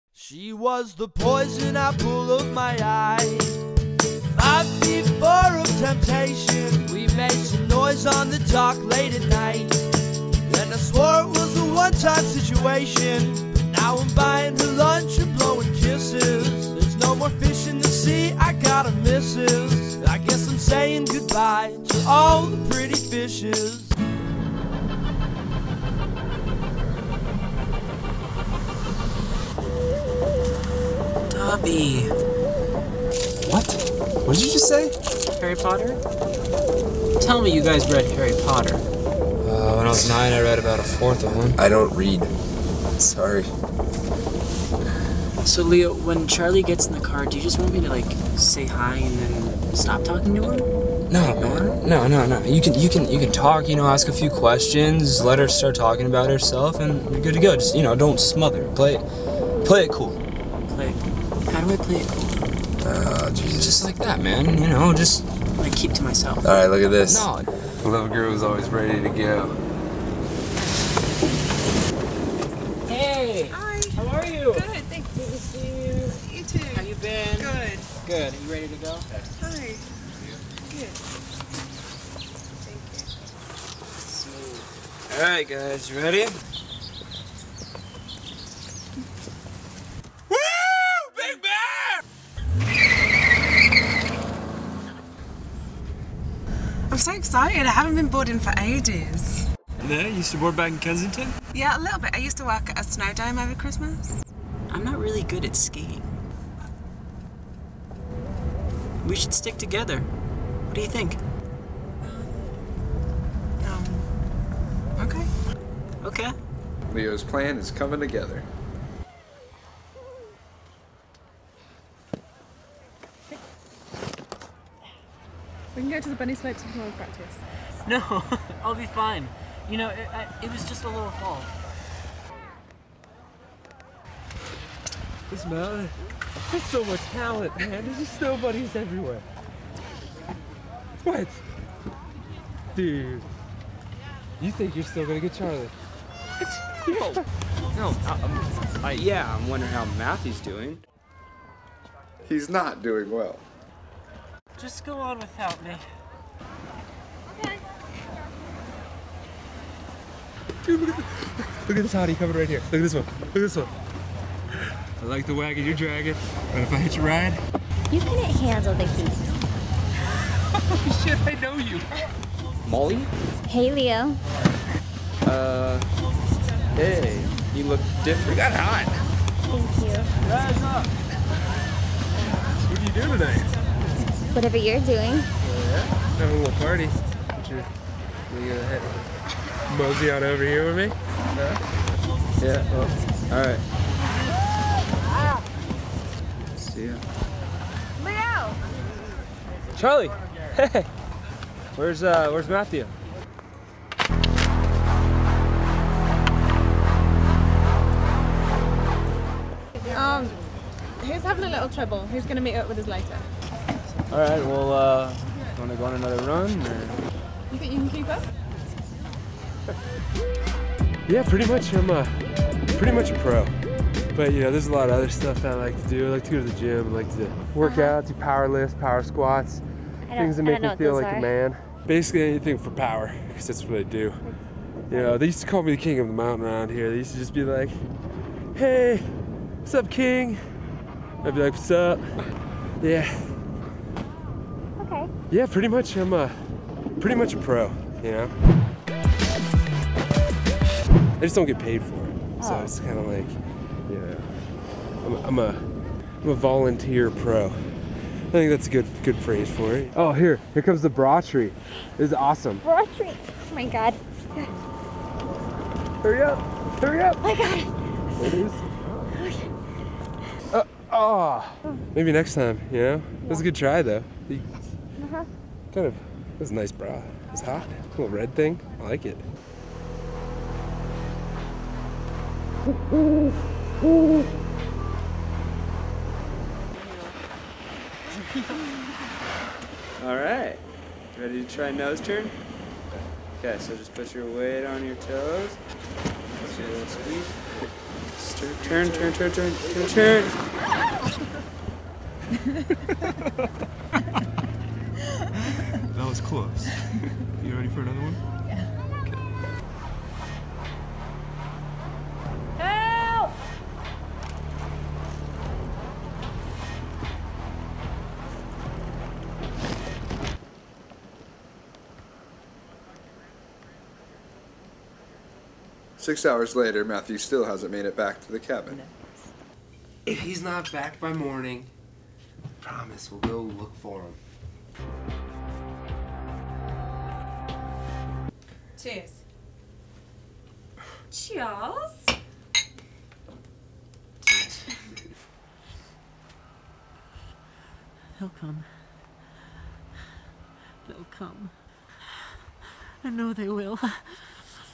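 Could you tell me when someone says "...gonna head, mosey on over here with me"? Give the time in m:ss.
3:08.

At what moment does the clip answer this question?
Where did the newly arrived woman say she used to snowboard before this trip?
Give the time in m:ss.
1:40.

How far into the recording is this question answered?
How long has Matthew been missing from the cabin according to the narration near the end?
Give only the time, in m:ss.
5:25.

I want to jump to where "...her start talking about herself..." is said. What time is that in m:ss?
0:55.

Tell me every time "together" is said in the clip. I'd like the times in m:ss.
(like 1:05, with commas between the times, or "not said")
1:49, 1:57.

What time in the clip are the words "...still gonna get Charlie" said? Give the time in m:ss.
2:24.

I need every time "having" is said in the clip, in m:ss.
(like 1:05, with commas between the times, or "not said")
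3:06, 3:31.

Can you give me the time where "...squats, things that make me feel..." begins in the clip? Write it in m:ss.
3:49.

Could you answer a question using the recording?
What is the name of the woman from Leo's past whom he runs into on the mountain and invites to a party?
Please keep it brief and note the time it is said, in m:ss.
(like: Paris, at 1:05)
Molly, at 2:52.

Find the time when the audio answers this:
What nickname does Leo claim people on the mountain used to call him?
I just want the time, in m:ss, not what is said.
3:55.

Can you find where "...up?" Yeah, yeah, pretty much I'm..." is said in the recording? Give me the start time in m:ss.
4:01.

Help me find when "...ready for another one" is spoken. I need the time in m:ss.
5:07.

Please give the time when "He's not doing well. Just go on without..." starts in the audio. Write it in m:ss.
2:32.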